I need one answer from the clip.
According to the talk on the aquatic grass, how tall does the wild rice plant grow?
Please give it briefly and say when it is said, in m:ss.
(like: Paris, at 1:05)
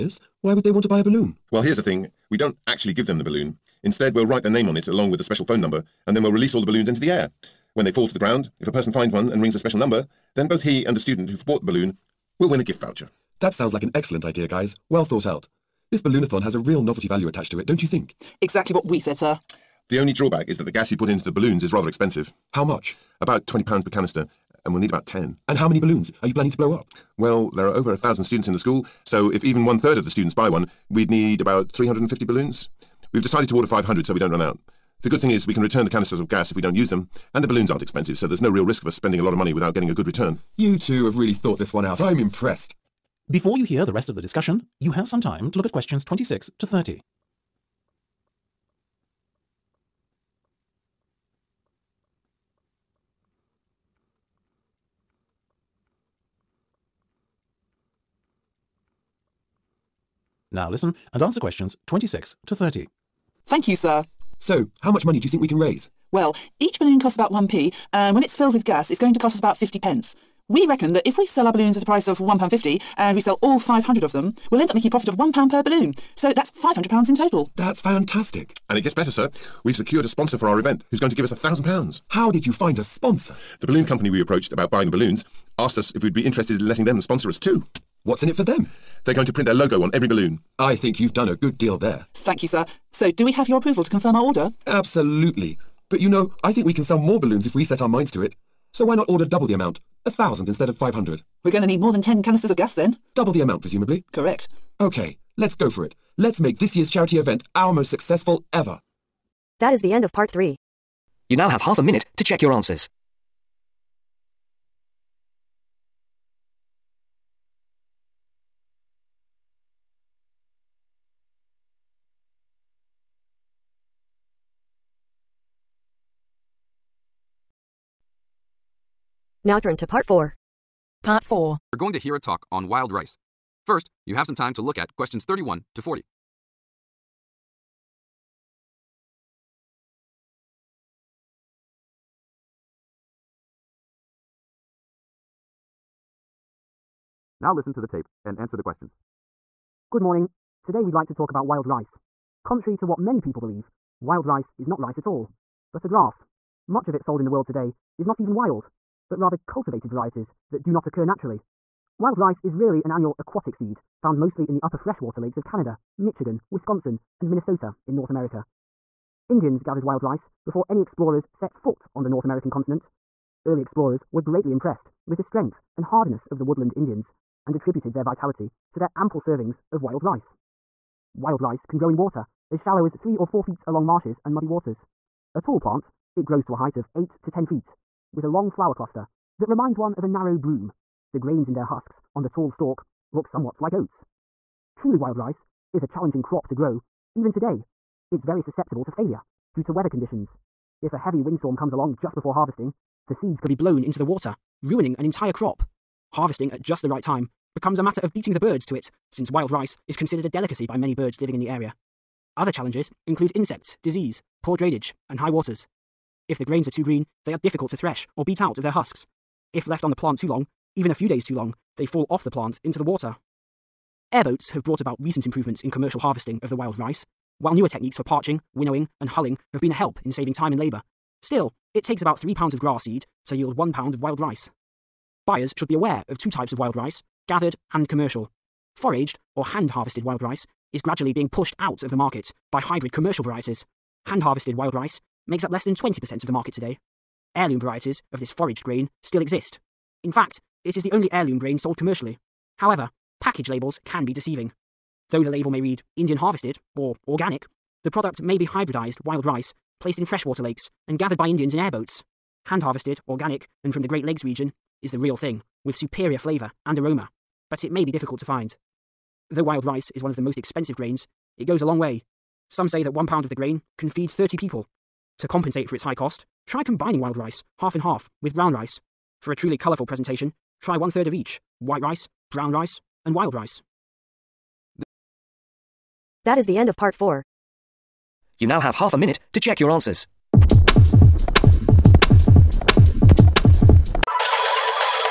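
8 to 10 feet, at 3:06.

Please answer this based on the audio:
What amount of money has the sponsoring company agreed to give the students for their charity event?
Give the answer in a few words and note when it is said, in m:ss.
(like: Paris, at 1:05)
£1,000, at 1:21.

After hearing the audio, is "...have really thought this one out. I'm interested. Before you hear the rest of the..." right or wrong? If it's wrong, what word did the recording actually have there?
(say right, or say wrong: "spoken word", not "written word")
wrong: "impressed", not "interested".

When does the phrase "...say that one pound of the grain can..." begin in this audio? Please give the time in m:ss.
4:32.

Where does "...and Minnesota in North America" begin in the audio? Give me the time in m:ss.
2:47.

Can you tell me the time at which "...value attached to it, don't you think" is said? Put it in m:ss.
0:17.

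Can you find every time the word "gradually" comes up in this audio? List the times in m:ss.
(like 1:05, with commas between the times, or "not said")
4:00.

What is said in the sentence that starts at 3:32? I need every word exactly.
Other challenges include insects, disease, poor drainage, and high waters.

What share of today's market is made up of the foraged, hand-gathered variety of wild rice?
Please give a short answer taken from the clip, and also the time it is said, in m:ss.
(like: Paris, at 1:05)
less than 20%, at 4:05.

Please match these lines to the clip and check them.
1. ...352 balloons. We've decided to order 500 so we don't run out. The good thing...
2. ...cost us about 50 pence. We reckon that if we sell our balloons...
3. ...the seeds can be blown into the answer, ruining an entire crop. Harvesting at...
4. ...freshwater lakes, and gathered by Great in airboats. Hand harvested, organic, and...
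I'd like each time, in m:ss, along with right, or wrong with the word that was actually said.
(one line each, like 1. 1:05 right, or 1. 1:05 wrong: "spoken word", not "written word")
1. 0:31 wrong: "350", not "352"
2. 1:09 right
3. 3:23 wrong: "water", not "answer"
4. 4:20 wrong: "Indians", not "Great".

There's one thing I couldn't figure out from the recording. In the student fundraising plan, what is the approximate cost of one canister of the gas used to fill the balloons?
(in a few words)
£20.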